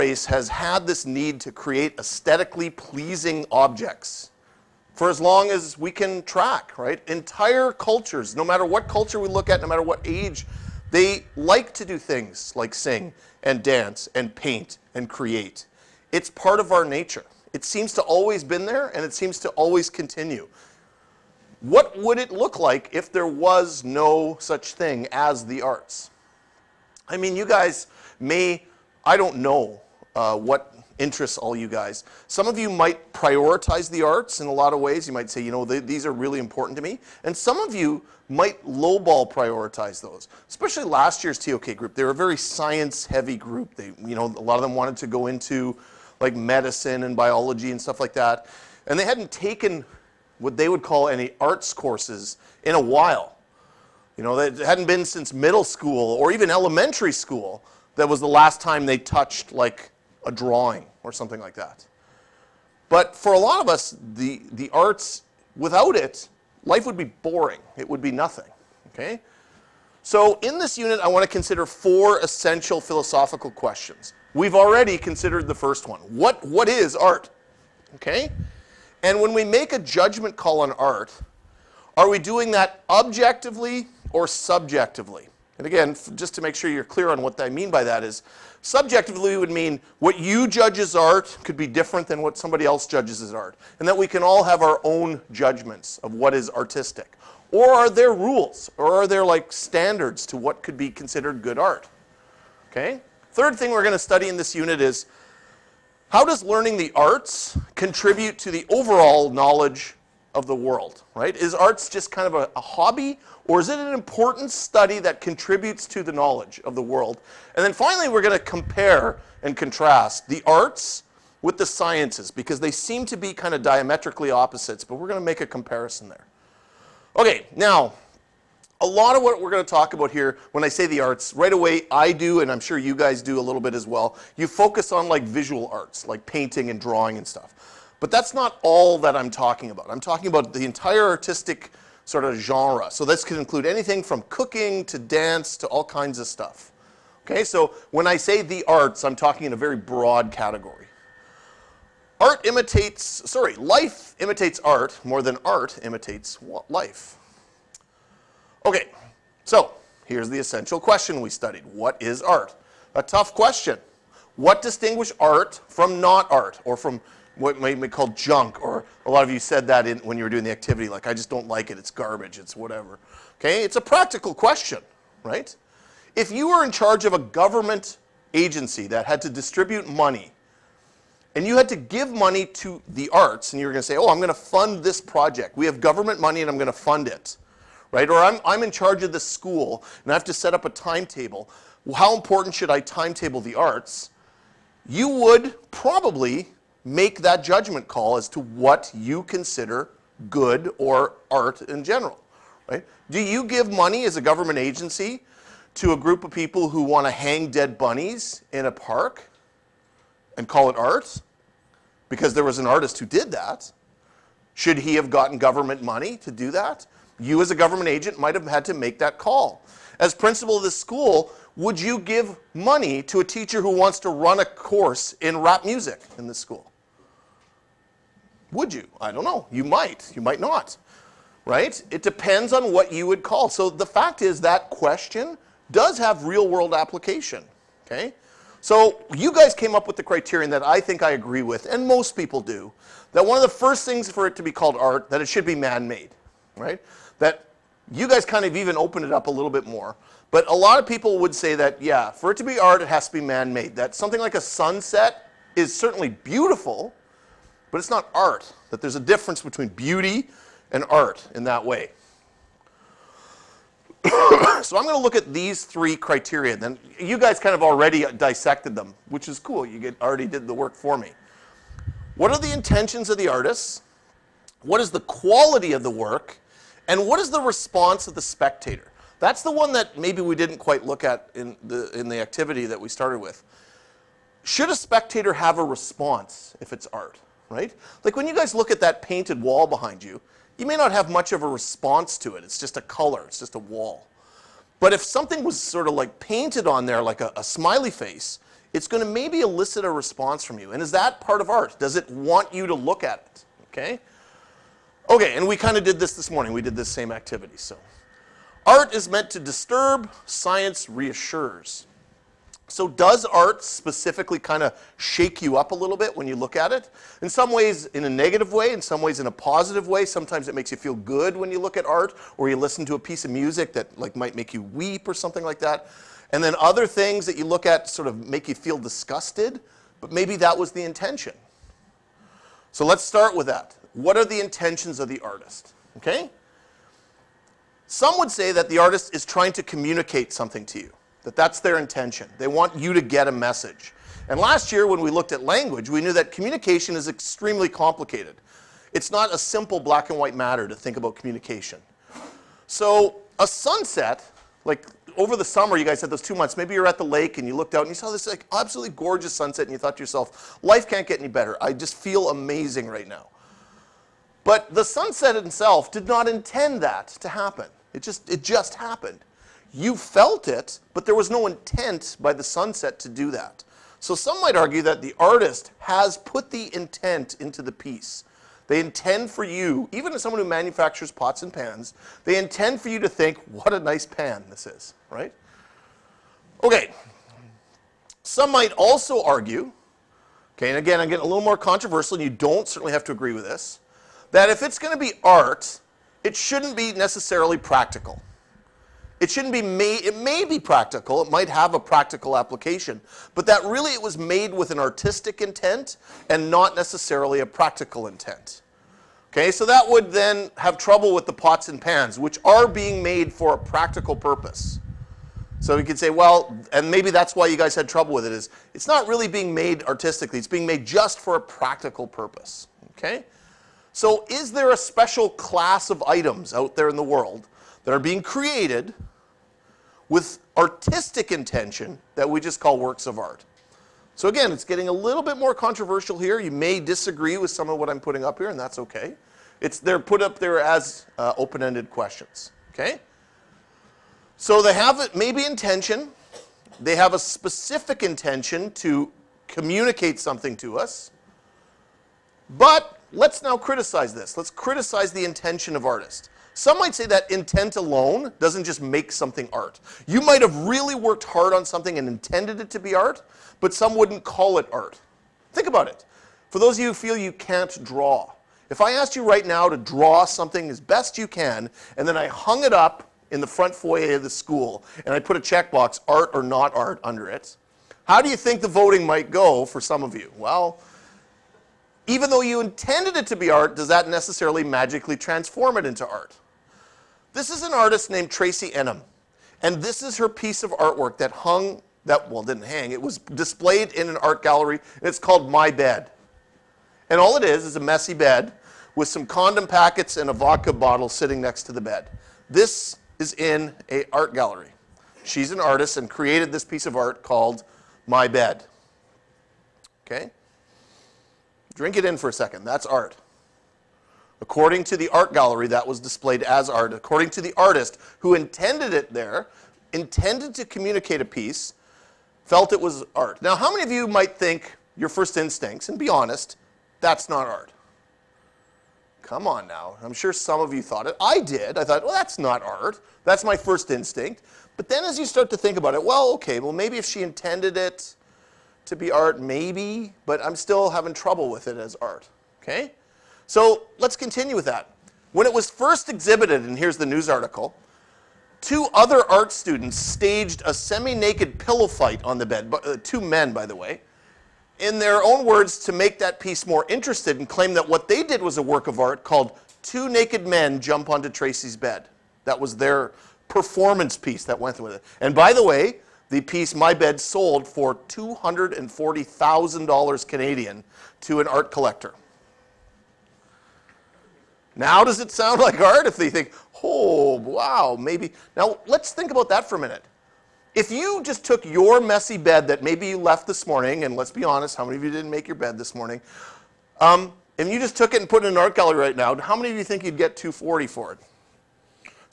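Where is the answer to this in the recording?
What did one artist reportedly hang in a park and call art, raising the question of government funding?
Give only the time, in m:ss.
3:27.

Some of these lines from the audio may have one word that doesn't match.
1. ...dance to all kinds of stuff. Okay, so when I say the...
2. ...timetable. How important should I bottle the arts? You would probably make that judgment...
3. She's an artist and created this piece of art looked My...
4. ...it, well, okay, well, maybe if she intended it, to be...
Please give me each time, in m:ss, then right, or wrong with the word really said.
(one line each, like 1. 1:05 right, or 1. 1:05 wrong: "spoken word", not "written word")
1. 2:24 right
2. 3:10 wrong: "timetable", not "bottle"
3. 8:25 wrong: "called", not "looked"
4. 8:55 right.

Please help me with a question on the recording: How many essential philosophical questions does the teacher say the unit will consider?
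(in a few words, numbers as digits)
4.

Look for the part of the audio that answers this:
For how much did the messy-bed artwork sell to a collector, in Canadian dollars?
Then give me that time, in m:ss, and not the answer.
9:27.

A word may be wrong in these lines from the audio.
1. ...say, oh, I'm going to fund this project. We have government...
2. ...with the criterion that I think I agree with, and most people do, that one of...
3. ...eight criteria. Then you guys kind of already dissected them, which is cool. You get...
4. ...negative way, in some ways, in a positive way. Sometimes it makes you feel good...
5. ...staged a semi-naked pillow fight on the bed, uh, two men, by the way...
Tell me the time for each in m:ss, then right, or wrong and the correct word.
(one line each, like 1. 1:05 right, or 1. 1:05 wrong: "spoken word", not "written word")
1. 3:03 right
2. 3:59 right
3. 4:25 wrong: "three", not "eight"
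4. 5:18 right
5. 9:09 right.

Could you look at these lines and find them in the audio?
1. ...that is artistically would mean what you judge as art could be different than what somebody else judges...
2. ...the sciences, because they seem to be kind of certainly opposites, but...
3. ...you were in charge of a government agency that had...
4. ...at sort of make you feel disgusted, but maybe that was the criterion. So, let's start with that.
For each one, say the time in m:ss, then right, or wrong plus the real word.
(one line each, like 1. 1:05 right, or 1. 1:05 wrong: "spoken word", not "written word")
1. 1:27 wrong: "subjectively", not "artistically"
2. 2:01 wrong: "diametrically", not "certainly"
3. 2:56 right
4. 5:27 wrong: "intention", not "criterion".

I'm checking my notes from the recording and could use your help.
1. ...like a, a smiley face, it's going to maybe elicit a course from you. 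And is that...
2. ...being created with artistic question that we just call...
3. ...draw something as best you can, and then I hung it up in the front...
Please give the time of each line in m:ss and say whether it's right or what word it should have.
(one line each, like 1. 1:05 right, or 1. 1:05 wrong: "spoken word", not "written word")
1. 4:57 wrong: "response", not "course"
2. 7:07 wrong: "intention", not "question"
3. 7:49 right.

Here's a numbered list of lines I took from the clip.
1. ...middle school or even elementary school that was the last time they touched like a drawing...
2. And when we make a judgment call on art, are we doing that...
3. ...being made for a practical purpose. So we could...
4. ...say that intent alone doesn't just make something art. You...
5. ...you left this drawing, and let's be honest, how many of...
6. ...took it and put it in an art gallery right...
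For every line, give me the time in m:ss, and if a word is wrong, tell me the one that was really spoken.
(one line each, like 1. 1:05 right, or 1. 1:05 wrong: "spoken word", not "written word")
1. 0:55 right
2. 1:19 right
3. 6:52 right
4. 7:36 right
5. 9:43 wrong: "morning", not "drawing"
6. 9:47 right.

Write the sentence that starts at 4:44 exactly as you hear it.
Should a spectator have a response if it's art, right?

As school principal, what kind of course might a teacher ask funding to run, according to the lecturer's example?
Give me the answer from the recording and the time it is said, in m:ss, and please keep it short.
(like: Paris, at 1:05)
rap music, at 3:45.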